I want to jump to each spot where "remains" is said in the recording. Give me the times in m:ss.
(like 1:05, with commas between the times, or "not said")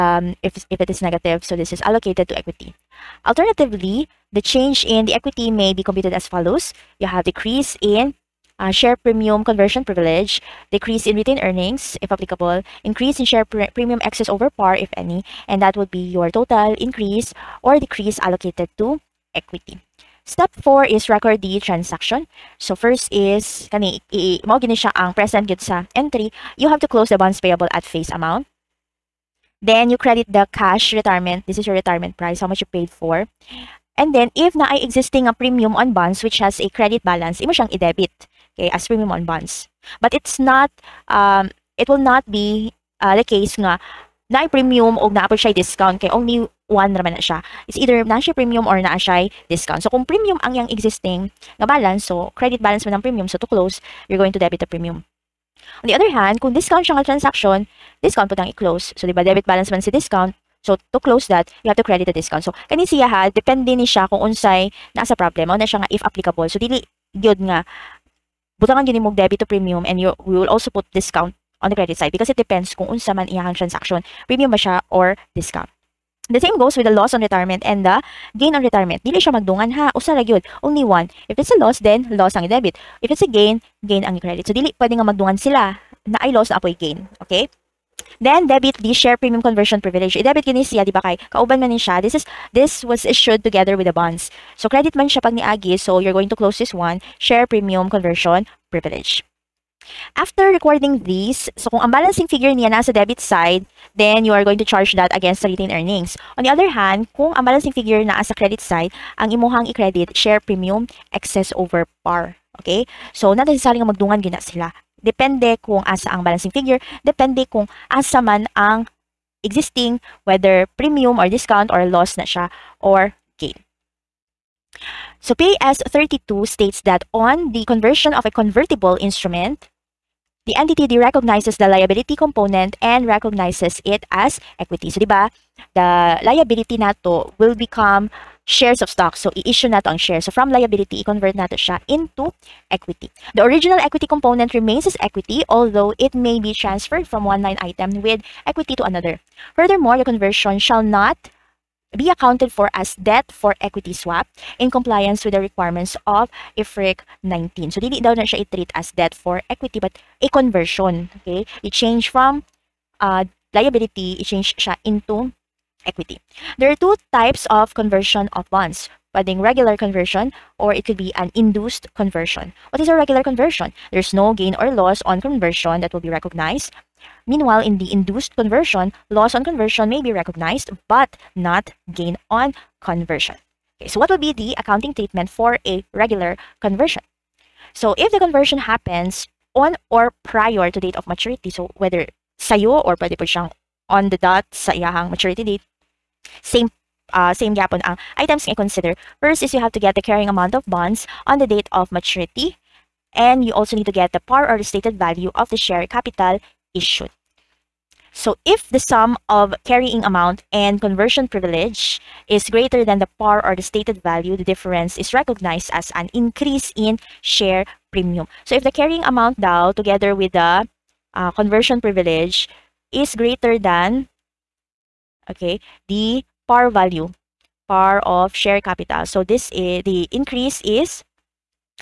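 2:24.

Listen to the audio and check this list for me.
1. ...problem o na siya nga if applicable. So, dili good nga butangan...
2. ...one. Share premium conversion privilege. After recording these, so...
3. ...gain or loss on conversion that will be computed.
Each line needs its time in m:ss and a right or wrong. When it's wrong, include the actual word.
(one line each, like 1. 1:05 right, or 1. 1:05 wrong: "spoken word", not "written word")
1. 1:05 right
2. 1:36 right
3. 2:54 wrong: "recognized", not "computed".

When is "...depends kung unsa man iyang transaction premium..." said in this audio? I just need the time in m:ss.
1:12.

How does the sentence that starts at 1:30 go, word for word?
I-debit gini siya, di ba kay?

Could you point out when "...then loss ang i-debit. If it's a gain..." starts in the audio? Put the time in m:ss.
1:21.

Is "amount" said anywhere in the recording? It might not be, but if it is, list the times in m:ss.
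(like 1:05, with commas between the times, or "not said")
0:28, 3:20, 3:30, 3:39.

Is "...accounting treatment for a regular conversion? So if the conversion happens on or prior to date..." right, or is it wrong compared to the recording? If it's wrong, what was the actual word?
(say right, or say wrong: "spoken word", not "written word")
right.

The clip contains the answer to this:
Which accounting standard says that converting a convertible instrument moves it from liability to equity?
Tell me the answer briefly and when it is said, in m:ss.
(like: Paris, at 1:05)
PAS 32, at 2:05.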